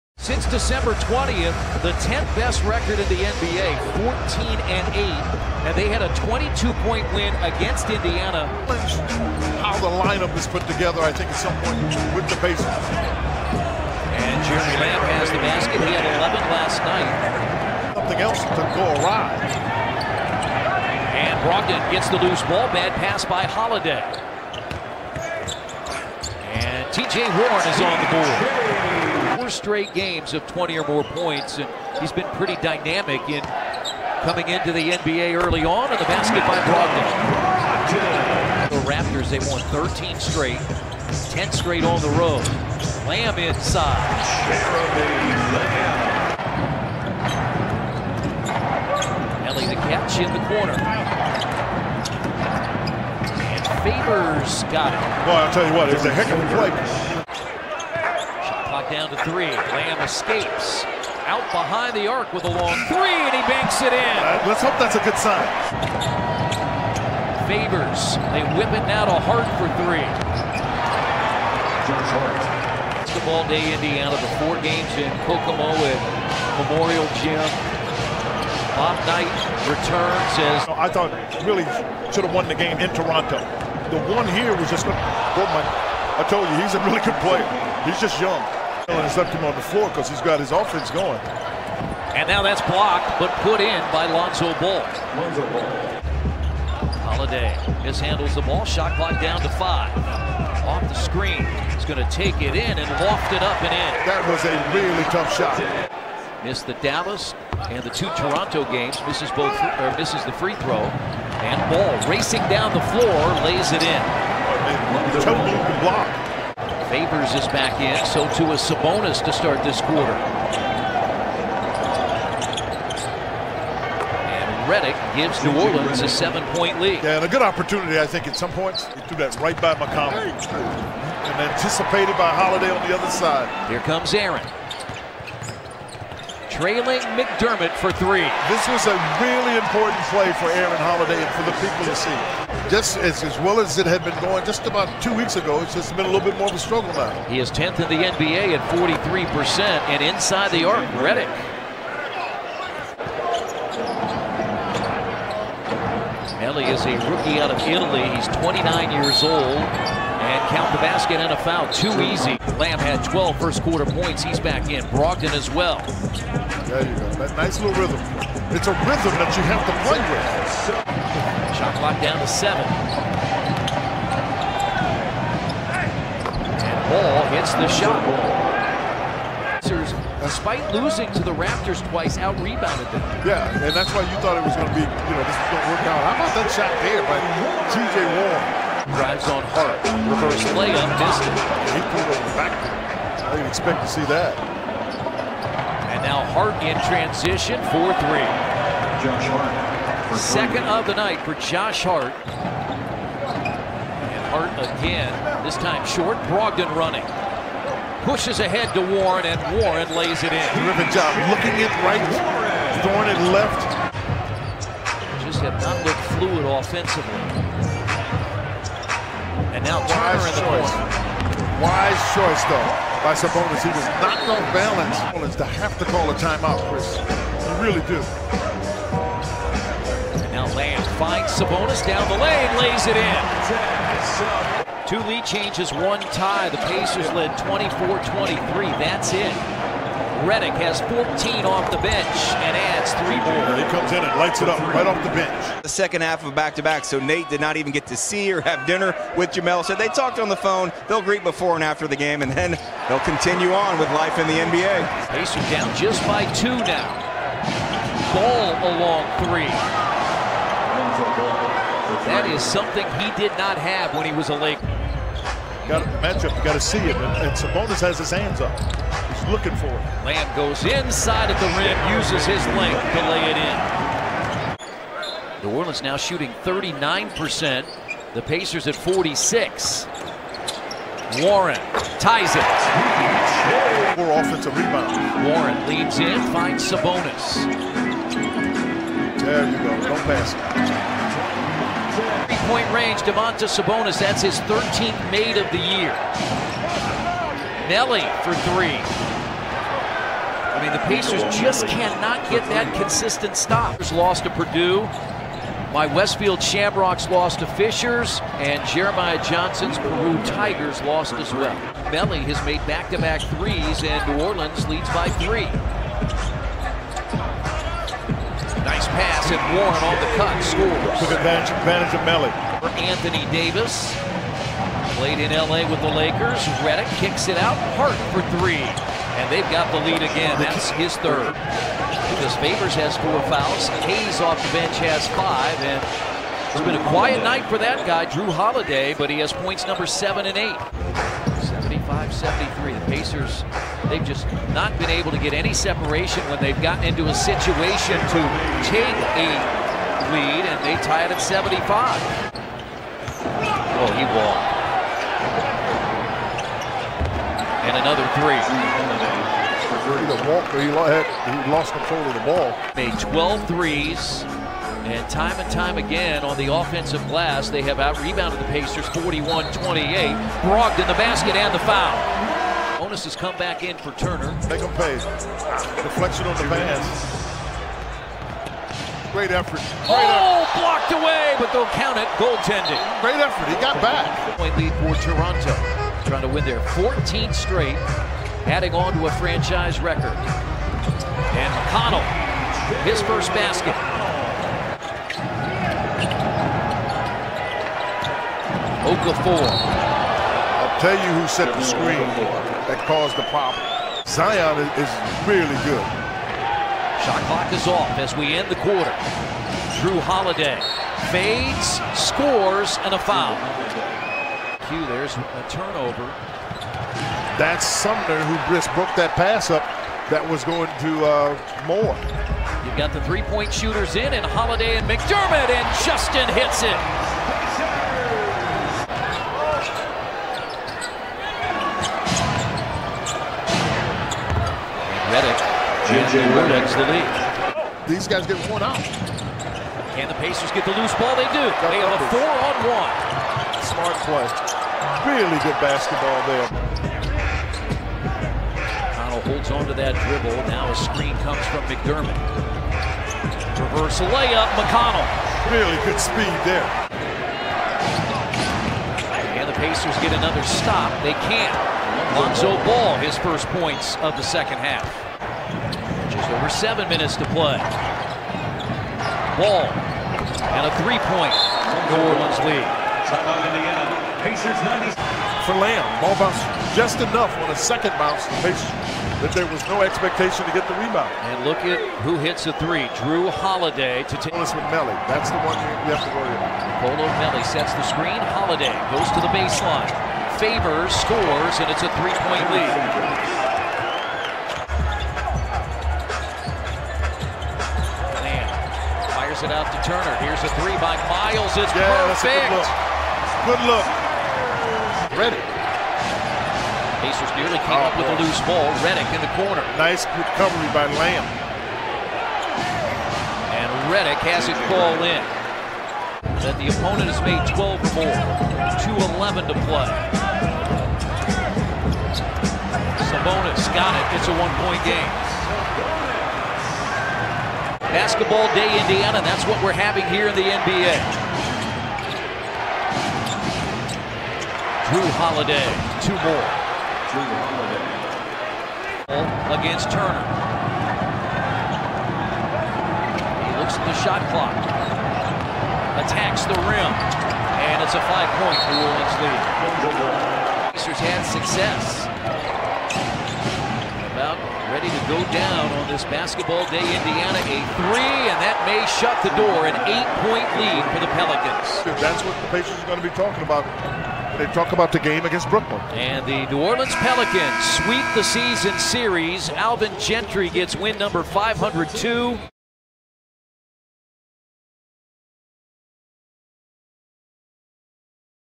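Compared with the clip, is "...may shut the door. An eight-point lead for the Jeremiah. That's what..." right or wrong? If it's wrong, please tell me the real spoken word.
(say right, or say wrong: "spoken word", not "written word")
wrong: "Pelicans", not "Jeremiah".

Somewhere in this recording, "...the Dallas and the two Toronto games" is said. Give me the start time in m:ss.
1:46.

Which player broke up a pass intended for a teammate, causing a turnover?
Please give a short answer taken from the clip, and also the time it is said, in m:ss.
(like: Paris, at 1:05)
Sumner, at 6:57.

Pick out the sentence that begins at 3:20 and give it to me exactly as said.
Second of the night for Josh Hart.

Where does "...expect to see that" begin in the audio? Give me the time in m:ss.
3:13.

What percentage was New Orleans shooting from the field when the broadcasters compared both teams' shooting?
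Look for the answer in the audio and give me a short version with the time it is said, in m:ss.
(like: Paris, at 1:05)
39%, at 4:36.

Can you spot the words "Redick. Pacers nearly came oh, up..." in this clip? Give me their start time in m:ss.
8:25.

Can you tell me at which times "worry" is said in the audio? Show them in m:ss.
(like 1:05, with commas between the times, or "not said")
8:06.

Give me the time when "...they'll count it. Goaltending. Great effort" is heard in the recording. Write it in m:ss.
6:21.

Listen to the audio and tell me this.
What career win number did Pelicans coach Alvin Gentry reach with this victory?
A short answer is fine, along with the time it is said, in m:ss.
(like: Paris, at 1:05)
502, at 9:31.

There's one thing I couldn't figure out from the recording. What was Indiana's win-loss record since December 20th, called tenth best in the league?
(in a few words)
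14-8.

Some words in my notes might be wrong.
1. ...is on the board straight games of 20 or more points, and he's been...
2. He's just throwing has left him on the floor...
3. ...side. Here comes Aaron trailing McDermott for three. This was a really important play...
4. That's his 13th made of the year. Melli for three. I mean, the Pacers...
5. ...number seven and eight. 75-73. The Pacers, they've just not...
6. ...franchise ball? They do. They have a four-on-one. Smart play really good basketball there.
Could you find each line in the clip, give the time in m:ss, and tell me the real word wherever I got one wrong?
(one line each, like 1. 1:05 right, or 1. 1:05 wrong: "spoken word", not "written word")
1. 0:27 right
2. 1:27 wrong: "young", not "throwing"
3. 2:13 right
4. 4:53 right
5. 5:39 right
6. 7:20 wrong: "loose", not "franchise".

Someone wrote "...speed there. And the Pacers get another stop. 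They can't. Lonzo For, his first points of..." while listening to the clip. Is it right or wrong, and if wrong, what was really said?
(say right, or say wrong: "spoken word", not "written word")
wrong: "Ball", not "For".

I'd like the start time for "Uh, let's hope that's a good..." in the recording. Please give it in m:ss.
1:04.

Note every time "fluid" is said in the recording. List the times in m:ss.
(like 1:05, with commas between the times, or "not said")
3:36.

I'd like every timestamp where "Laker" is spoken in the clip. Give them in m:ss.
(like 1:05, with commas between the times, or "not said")
4:24, 5:25.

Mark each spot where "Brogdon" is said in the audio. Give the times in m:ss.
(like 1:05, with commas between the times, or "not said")
0:21, 0:36, 2:44, 3:26, 6:10.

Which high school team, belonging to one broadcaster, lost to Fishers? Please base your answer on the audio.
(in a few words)
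Westfield Shamrocks.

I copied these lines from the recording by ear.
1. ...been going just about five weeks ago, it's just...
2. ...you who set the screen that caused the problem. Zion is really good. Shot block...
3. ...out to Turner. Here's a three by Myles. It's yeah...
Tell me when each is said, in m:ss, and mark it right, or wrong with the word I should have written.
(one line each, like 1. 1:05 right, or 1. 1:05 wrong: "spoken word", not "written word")
1. 2:24 wrong: "two", not "five"
2. 6:40 wrong: "clock", not "block"
3. 8:19 right.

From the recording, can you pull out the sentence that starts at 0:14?
And Jeremy Lamb has the basket.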